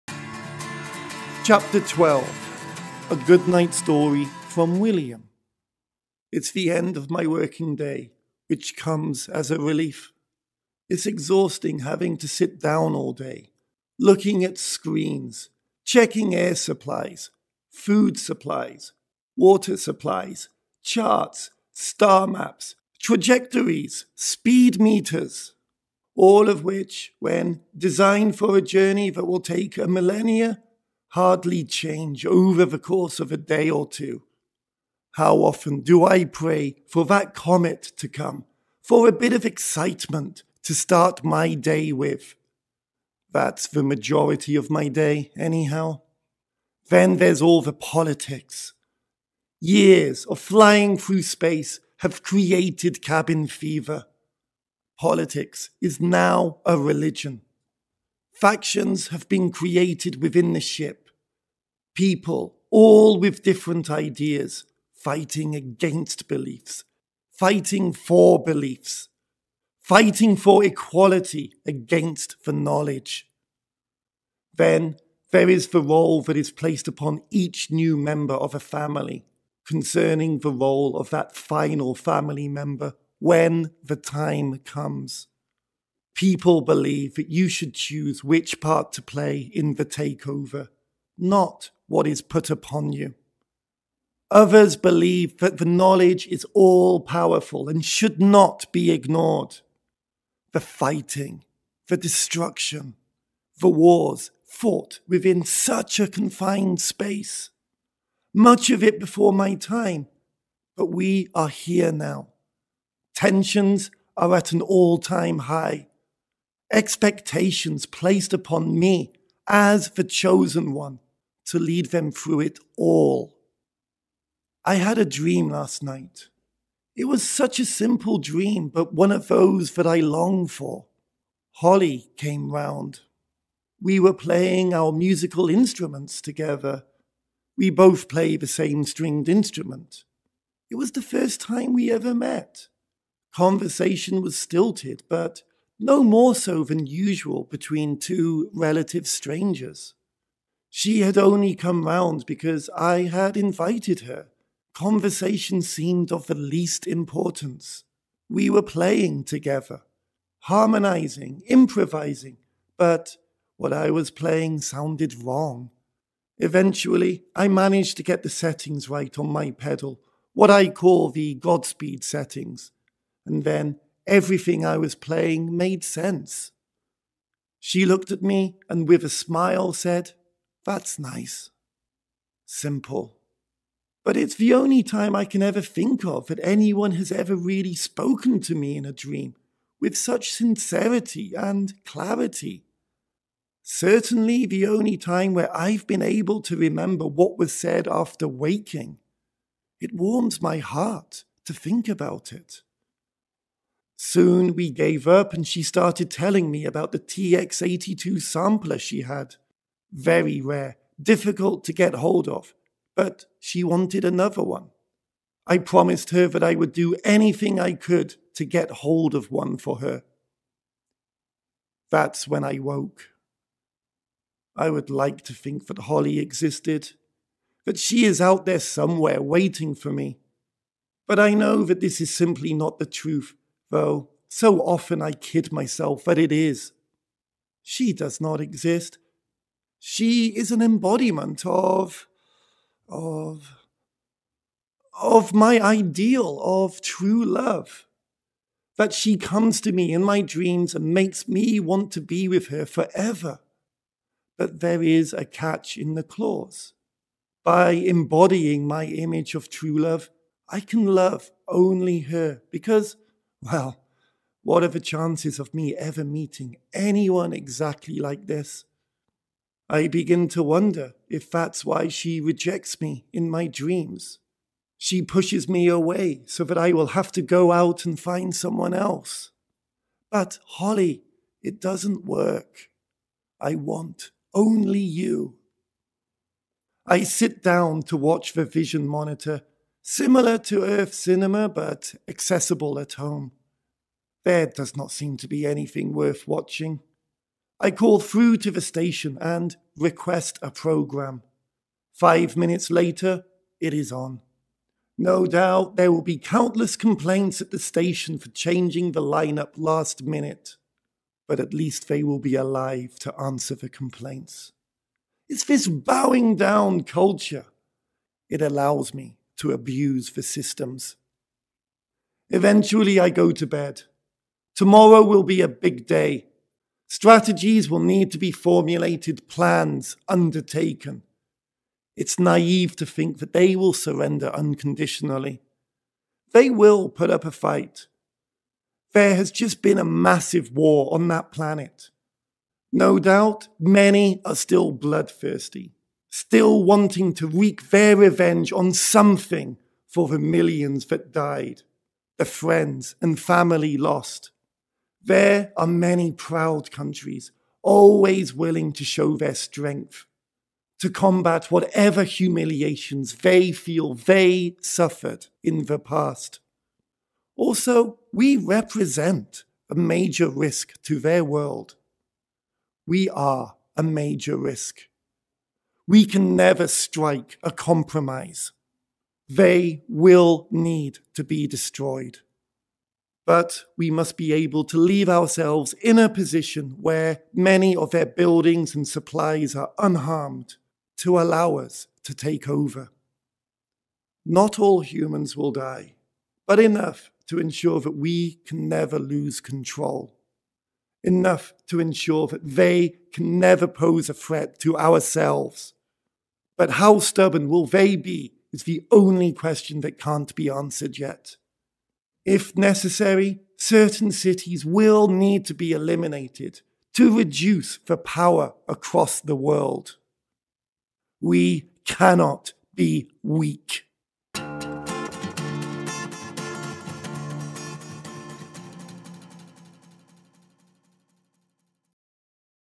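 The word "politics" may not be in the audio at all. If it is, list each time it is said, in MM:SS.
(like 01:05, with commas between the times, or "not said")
00:47, 00:54.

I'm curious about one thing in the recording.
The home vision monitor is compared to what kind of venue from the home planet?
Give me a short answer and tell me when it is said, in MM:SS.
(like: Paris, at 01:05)
Earth cinema, at 04:50.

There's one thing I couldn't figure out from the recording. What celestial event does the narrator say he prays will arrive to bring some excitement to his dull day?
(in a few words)
comet.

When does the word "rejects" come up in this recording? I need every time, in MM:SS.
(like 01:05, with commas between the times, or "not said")
04:32.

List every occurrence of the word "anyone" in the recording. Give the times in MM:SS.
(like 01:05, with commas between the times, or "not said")
03:06, 04:26.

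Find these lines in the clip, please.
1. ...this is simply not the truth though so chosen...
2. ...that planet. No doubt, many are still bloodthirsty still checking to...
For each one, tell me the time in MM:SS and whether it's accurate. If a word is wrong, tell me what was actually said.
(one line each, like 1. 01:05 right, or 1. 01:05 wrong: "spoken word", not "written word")
1. 03:51 wrong: "often", not "chosen"
2. 05:41 wrong: "wanting", not "checking".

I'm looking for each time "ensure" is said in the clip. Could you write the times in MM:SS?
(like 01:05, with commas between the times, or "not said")
06:37, 06:41.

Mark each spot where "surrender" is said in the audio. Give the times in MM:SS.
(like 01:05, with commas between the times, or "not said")
05:33.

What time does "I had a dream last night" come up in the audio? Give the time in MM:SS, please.
02:04.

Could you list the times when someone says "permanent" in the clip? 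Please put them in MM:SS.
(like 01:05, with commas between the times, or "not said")
not said.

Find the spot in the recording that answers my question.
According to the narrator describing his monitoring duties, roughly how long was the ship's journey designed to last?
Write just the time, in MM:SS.
00:29.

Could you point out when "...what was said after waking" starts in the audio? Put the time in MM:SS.
03:17.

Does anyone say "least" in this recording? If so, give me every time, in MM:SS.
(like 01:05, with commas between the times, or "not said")
02:36, 05:11.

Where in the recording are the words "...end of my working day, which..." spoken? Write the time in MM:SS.
00:06.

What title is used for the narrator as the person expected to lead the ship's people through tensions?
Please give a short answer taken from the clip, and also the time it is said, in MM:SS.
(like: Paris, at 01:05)
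the chosen one, at 01:59.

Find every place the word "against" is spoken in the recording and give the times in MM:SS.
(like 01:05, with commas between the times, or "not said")
01:05, 01:11.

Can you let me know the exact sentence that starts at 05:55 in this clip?
There are many proud countries always willing to show their strength, to combat whatever humiliations they feel they suffered in the past.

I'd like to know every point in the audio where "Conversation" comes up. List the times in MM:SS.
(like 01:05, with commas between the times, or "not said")
02:23, 02:34.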